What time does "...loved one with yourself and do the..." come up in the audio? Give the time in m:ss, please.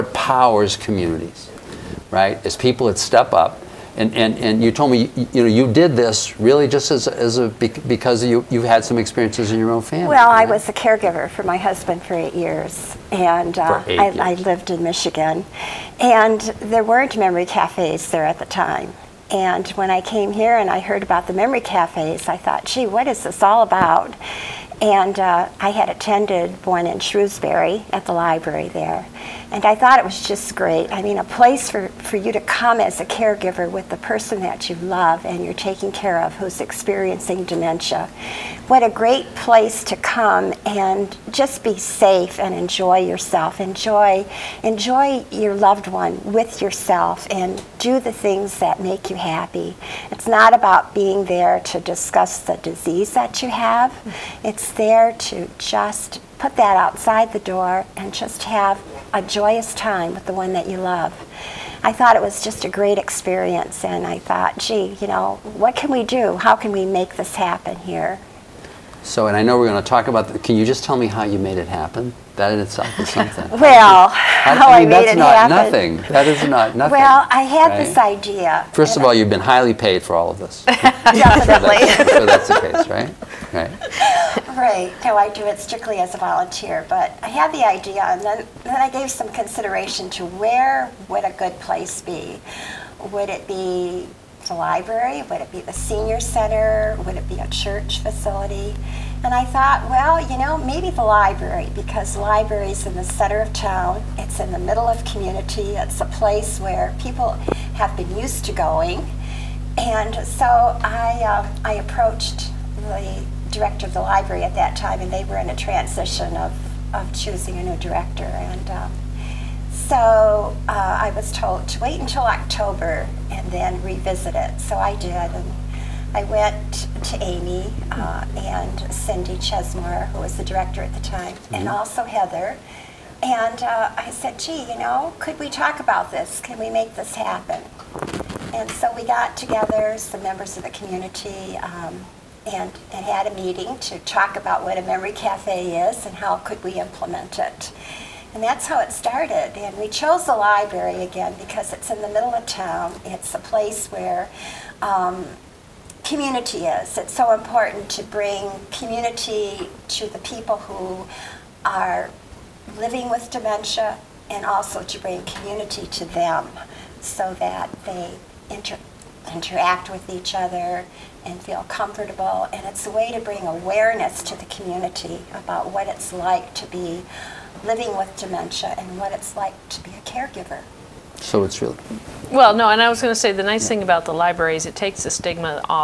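0:45.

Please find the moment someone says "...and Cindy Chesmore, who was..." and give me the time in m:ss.
2:08.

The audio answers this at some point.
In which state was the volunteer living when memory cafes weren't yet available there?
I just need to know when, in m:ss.
0:14.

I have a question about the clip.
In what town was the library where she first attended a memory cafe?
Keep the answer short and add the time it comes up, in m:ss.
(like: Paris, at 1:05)
Shrewsbury, at 0:27.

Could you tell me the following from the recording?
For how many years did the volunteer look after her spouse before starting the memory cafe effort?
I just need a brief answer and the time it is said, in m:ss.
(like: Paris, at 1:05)
8, at 0:12.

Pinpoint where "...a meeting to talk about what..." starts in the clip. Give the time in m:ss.
2:23.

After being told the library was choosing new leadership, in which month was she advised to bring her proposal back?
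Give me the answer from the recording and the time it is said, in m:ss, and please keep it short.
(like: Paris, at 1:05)
October, at 2:02.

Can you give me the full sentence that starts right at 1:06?
How can we make this happen here?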